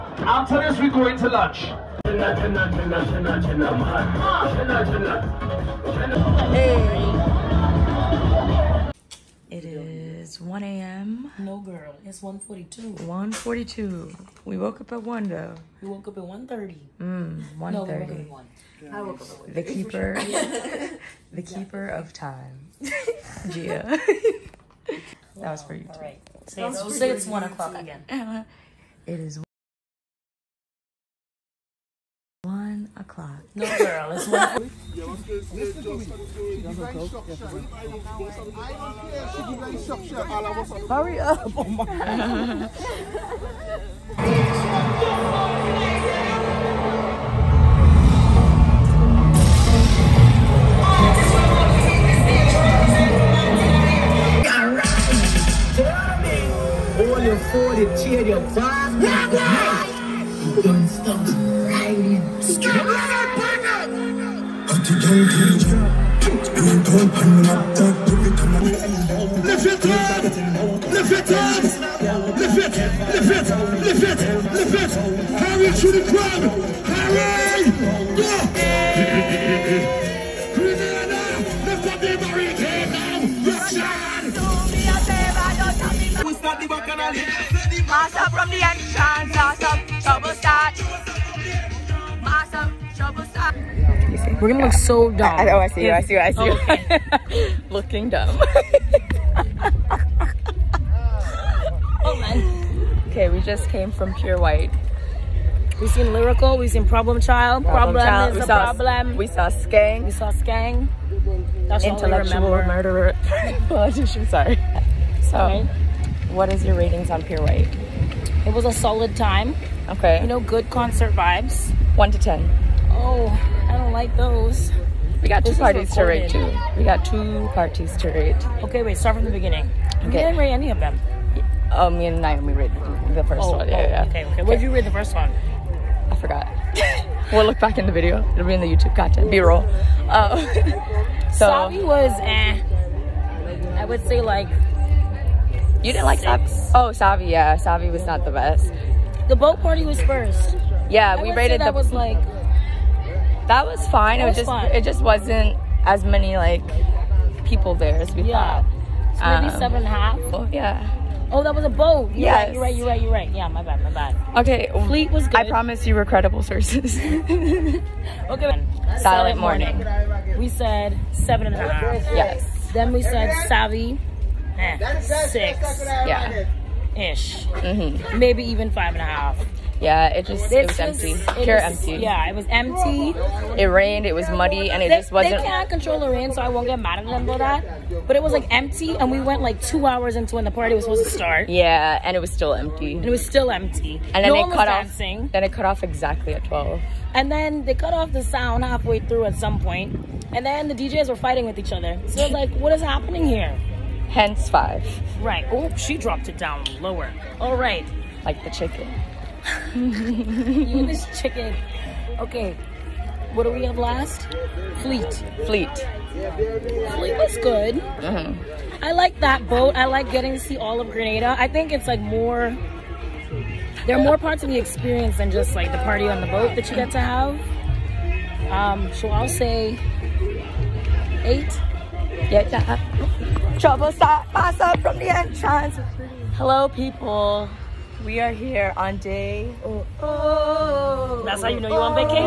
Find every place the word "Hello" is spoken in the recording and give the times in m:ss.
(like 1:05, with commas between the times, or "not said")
3:56.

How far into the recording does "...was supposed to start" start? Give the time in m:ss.
3:10.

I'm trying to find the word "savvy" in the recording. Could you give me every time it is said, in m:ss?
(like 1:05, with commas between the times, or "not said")
2:21, 2:53.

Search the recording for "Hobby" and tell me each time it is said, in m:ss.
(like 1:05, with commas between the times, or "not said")
not said.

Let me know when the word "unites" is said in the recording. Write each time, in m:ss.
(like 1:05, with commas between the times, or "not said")
not said.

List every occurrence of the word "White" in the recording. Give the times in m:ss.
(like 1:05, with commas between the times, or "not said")
1:44, 1:57.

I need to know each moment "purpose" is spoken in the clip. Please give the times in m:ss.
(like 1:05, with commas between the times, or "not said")
not said.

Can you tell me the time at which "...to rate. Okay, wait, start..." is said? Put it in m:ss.
2:07.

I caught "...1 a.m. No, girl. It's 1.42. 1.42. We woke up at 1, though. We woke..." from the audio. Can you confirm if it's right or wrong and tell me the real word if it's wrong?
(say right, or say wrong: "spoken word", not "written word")
right.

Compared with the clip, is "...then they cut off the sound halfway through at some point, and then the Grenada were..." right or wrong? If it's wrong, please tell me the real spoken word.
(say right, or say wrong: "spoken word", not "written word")
wrong: "DJs", not "Grenada".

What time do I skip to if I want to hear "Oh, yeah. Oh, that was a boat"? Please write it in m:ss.
2:40.